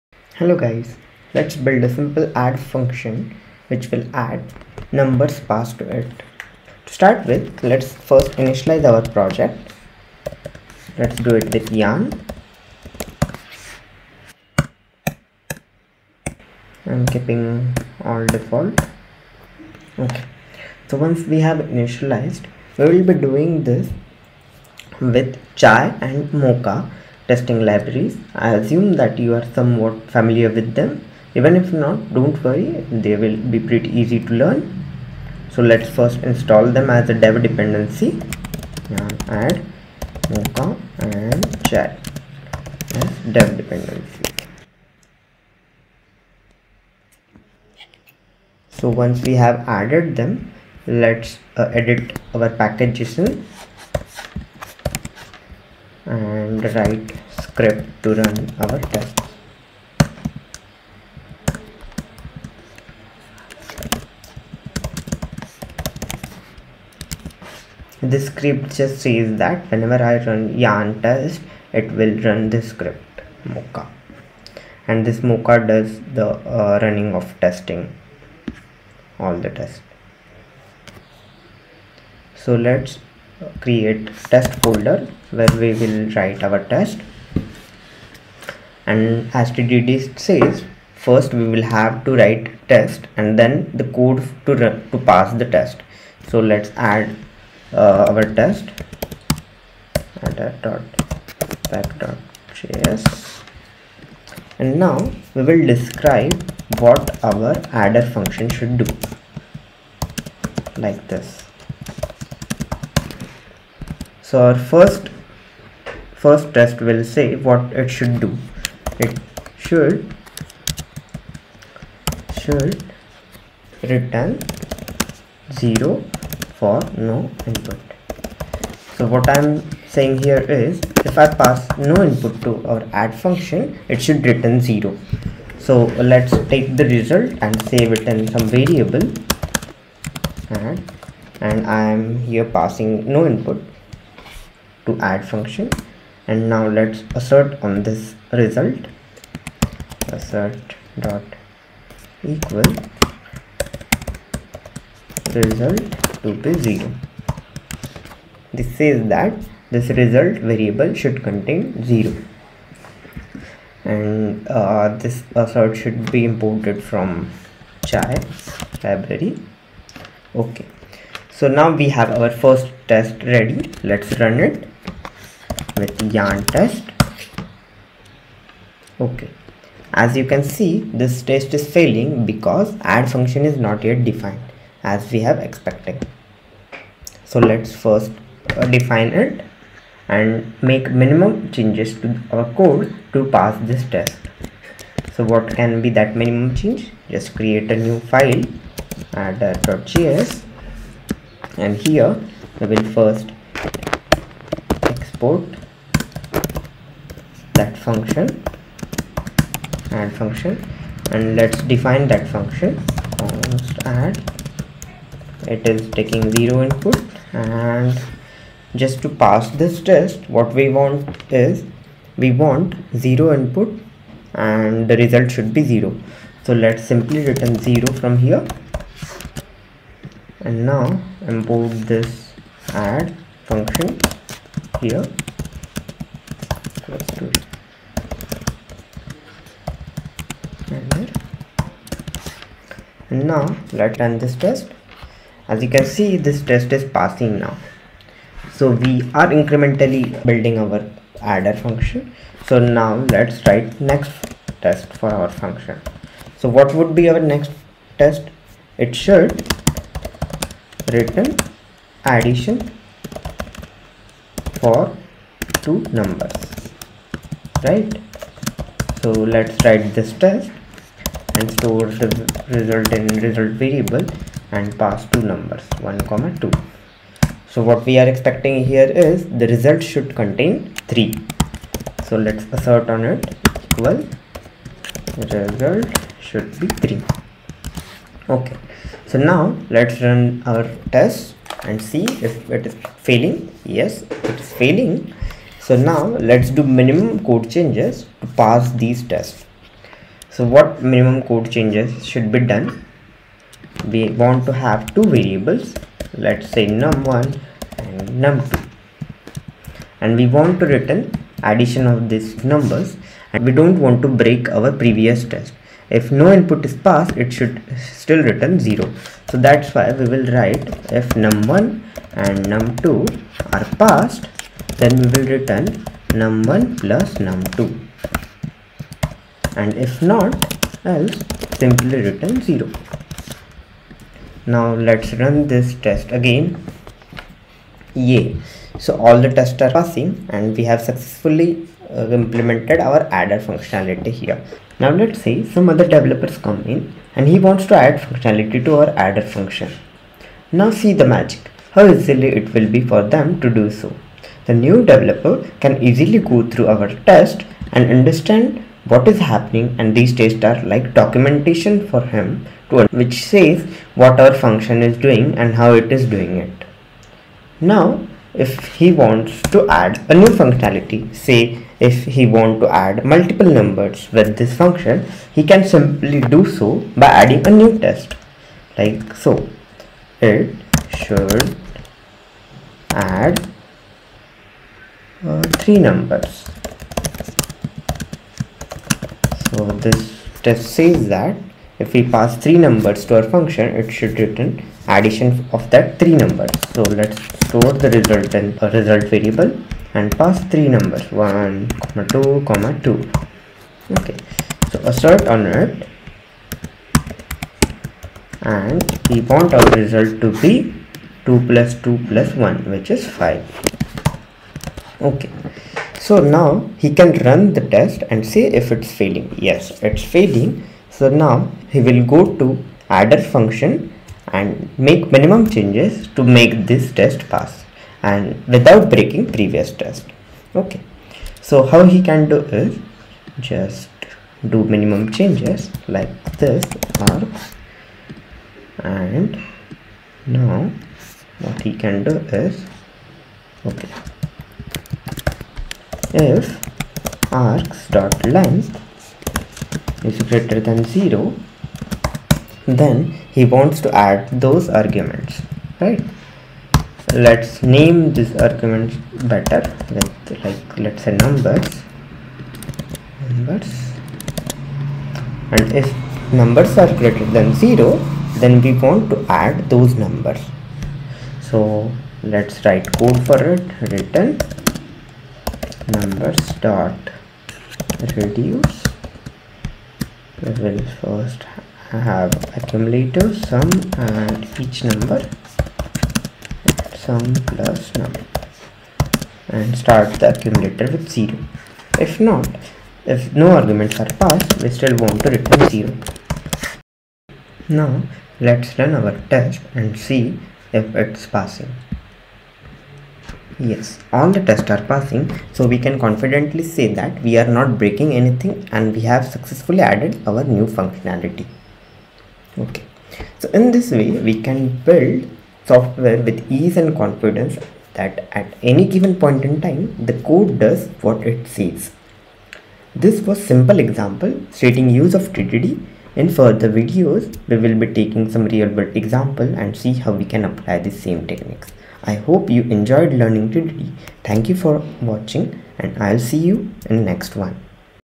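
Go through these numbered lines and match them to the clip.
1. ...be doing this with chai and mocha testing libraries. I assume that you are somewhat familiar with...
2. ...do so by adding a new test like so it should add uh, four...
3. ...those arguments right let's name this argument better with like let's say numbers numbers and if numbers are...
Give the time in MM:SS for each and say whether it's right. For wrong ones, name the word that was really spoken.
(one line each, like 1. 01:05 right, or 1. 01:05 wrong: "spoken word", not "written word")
1. 00:23 right
2. 06:16 wrong: "three", not "four"
3. 07:34 right.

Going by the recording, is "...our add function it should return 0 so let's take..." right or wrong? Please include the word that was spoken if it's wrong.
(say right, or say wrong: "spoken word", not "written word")
right.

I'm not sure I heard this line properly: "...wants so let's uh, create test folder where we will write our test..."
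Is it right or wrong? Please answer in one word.
wrong.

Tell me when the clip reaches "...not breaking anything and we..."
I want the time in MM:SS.
08:27.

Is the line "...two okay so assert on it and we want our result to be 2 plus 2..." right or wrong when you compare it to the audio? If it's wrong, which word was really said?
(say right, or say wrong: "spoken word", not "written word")
right.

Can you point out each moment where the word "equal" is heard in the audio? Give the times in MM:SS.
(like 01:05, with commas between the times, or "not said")
02:32, 04:43.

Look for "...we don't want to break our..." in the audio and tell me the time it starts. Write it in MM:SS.
05:13.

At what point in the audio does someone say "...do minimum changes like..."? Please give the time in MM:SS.
07:14.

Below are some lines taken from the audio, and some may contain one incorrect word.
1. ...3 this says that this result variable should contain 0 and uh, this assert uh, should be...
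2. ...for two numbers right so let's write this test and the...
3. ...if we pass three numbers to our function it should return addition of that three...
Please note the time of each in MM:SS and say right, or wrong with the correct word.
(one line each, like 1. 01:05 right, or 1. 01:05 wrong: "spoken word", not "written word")
1. 02:36 wrong: "0", not "3"
2. 04:24 right
3. 06:31 right.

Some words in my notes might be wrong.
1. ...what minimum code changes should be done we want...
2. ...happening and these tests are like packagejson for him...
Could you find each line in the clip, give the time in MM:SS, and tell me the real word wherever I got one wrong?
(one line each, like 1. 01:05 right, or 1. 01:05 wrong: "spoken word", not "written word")
1. 05:00 right
2. 05:59 wrong: "documentation", not "packagejson".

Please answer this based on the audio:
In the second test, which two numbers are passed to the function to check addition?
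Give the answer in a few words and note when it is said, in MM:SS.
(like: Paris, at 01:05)
1 and 2, at 04:35.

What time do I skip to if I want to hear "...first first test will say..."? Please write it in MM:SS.
01:54.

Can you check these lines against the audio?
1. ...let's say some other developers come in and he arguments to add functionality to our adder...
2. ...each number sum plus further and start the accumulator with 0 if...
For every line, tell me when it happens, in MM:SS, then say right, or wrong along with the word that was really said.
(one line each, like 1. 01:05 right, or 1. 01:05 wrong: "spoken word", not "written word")
1. 05:44 wrong: "wants", not "arguments"
2. 08:04 wrong: "number", not "further".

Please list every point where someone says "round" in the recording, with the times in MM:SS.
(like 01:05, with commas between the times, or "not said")
not said.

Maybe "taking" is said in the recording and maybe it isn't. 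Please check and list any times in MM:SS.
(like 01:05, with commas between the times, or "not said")
03:35, 08:47.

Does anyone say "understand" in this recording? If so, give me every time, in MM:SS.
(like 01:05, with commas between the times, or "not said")
05:57.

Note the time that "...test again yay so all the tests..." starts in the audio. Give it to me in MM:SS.
05:35.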